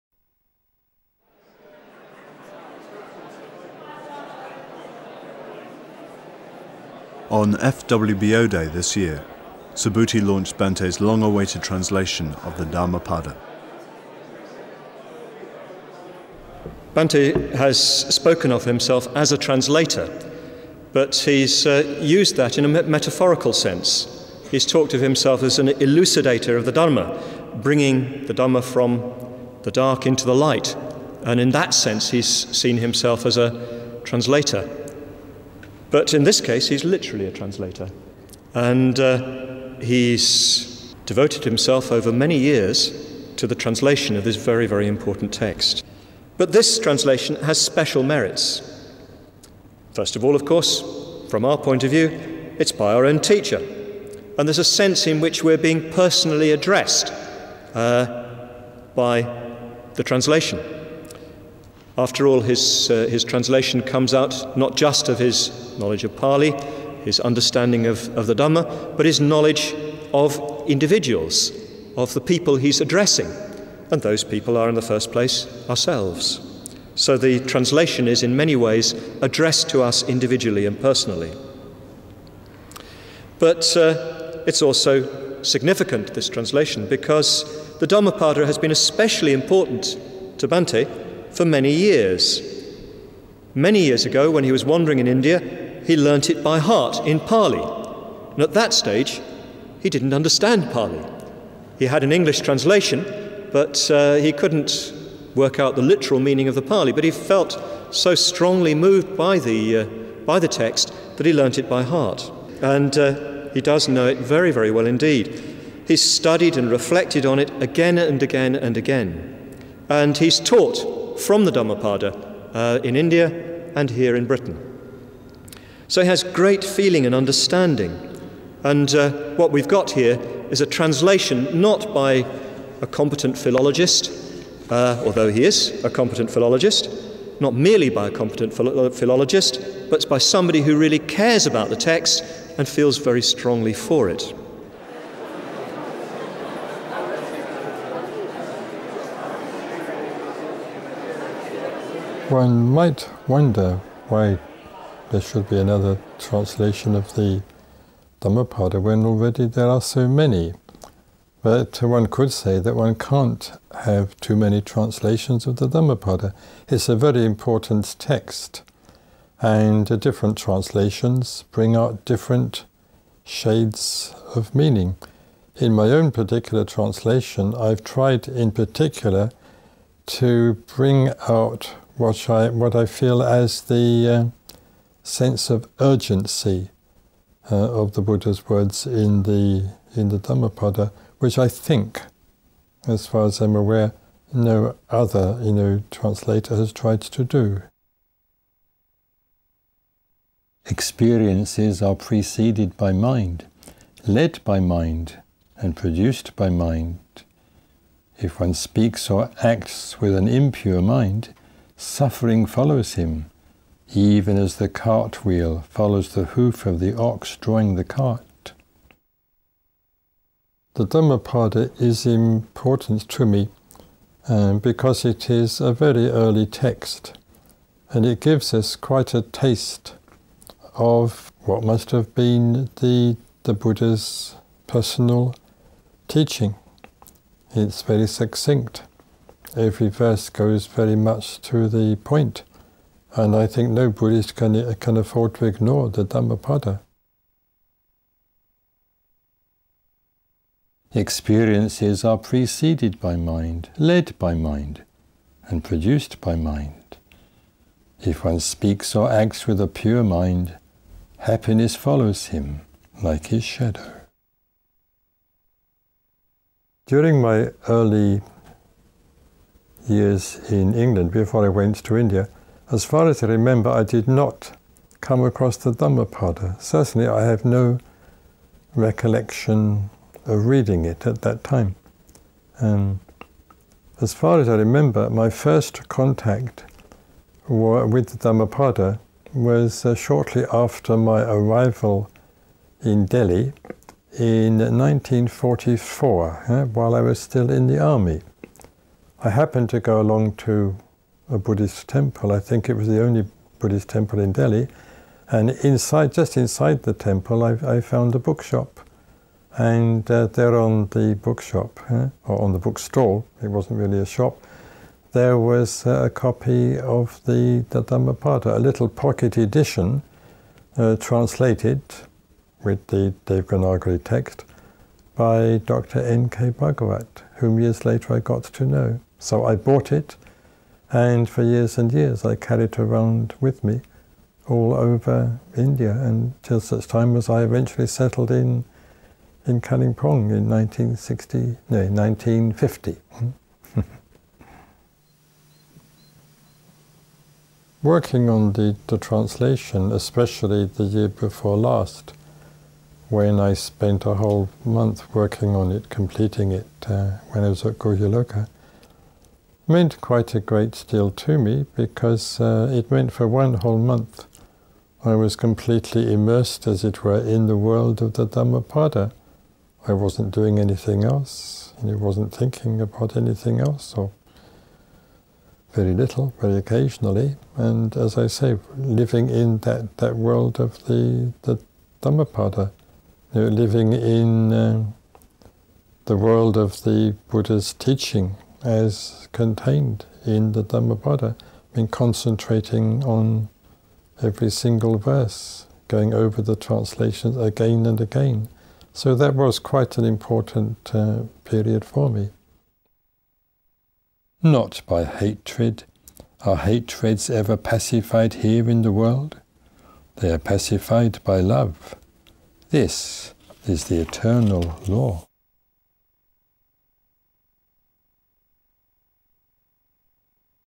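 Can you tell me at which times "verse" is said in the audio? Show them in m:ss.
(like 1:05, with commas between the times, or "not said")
3:59, 6:34.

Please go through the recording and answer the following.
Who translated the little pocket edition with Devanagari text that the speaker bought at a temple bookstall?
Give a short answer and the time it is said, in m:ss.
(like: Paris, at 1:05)
Dr. N.K. Bhagavat, at 5:25.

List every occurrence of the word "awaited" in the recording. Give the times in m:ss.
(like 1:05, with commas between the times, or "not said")
0:10.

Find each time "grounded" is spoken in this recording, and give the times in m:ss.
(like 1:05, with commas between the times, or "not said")
not said.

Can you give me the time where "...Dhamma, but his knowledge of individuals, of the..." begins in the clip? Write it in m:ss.
1:08.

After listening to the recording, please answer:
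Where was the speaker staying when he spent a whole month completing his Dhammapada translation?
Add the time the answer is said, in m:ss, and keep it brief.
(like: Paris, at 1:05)
Guhyaloka, at 5:57.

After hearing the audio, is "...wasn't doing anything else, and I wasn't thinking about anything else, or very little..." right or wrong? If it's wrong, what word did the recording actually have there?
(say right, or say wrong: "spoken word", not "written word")
right.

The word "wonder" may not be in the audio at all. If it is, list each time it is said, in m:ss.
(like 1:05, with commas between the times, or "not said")
2:33.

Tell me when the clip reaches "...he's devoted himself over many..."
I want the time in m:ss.
0:39.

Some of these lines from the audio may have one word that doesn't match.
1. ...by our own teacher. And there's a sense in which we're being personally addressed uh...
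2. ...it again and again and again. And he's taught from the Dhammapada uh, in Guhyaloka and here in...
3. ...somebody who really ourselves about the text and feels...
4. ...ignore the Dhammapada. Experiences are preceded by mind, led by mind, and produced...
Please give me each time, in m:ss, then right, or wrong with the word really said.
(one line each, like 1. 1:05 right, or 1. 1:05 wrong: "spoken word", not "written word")
1. 0:52 right
2. 1:57 wrong: "India", not "Guhyaloka"
3. 2:20 wrong: "cares", not "ourselves"
4. 4:05 right.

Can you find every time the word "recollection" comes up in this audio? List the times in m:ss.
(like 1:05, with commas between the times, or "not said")
4:38.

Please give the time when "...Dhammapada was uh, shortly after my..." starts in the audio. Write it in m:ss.
4:48.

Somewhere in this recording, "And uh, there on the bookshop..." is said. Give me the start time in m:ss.
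5:09.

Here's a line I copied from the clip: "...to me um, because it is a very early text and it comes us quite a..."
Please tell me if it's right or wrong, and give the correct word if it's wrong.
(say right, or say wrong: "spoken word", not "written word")
wrong: "gives", not "comes".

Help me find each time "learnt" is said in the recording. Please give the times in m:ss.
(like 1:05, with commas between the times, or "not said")
1:35, 1:51.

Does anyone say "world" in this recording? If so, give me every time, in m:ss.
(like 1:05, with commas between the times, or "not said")
6:07, 6:20, 6:26, 6:48.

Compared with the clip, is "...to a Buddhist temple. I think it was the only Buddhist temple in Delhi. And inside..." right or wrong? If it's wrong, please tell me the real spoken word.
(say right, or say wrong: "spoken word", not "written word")
right.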